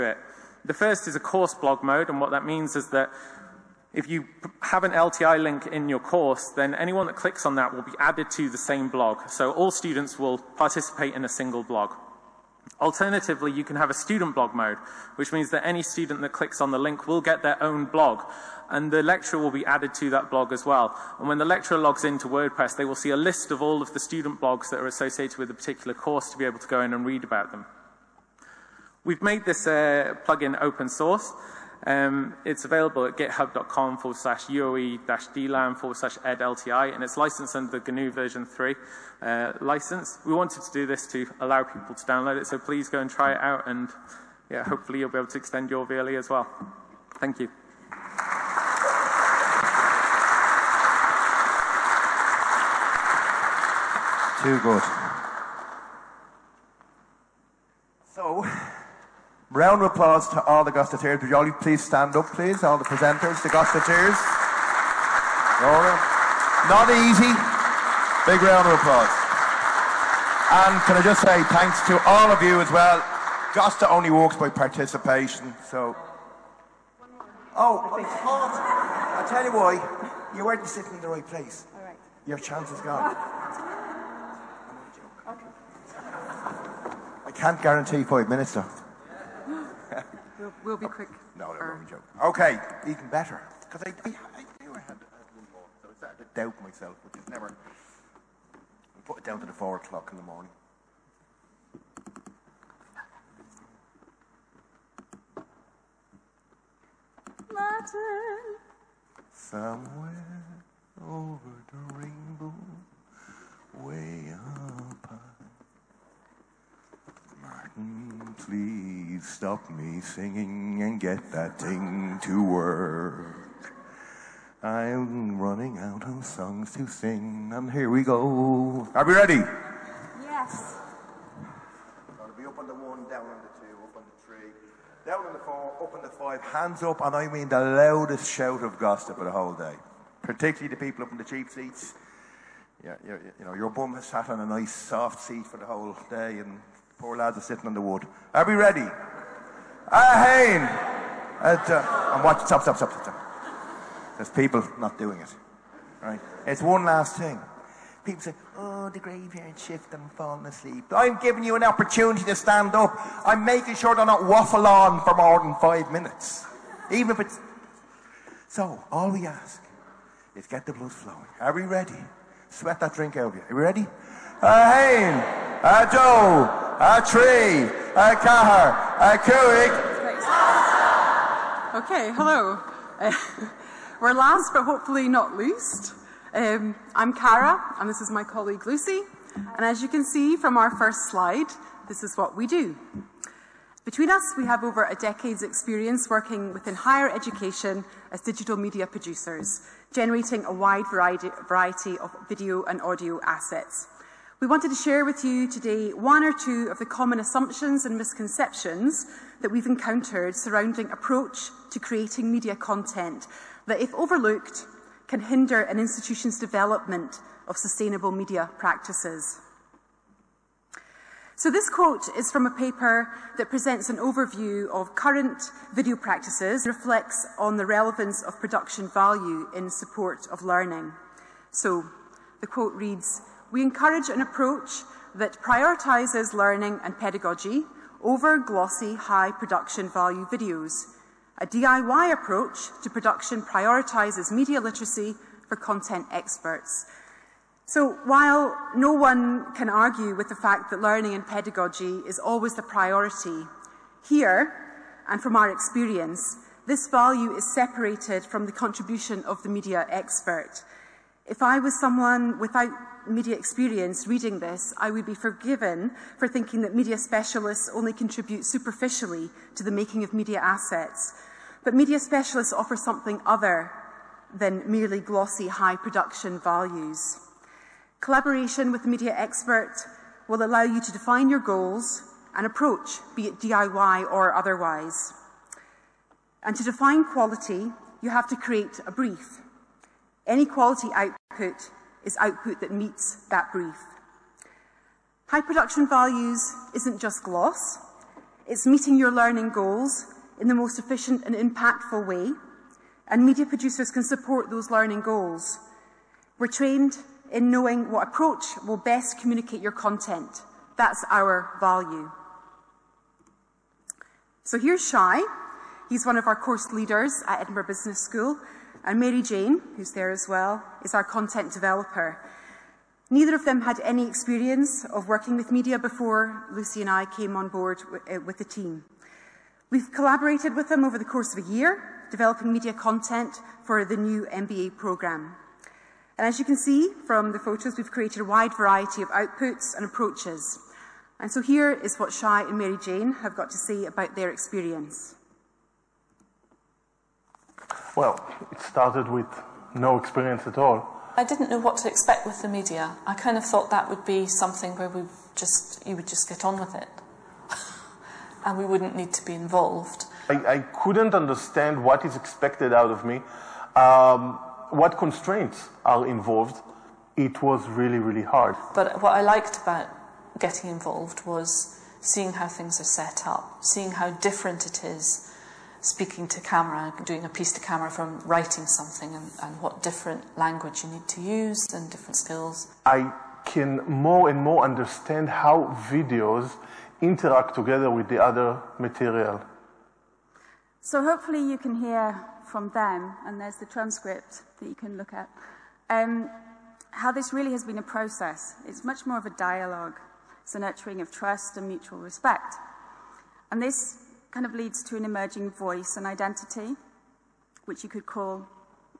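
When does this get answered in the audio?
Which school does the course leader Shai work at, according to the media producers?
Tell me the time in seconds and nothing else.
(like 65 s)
317 s.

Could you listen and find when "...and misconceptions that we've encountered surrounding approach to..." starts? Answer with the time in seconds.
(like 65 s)
207 s.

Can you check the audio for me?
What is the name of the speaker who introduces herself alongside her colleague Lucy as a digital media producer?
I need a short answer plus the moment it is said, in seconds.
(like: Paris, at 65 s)
Cara, at 187 s.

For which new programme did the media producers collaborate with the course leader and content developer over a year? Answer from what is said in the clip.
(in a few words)
MBA.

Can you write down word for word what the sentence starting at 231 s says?
So the quote reads, we encourage an approach that prioritises learning and pedagogy over glossy, high production value videos.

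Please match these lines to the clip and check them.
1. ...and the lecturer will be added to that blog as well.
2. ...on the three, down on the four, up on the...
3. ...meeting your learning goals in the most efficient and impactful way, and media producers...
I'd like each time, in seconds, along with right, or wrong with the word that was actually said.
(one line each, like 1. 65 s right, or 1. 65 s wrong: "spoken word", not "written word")
1. 18 s right
2. 133 s right
3. 298 s right.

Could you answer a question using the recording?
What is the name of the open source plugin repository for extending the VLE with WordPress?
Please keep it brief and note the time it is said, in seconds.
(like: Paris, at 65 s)
edLTI, at 36 s.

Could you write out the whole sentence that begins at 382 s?
I can more and more understand how videos interact together with the other material.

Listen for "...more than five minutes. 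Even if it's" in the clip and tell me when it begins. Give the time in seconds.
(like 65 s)
165 s.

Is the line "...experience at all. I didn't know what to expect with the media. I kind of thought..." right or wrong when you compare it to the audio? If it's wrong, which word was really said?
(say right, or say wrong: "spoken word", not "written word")
right.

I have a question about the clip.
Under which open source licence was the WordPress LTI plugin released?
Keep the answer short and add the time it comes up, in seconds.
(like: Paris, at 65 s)
GNU version 3, at 37 s.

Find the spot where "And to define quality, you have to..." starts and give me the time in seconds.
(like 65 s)
286 s.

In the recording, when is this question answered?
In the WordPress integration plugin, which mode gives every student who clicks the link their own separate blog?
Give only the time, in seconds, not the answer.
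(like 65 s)
13 s.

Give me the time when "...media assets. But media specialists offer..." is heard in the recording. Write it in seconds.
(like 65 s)
270 s.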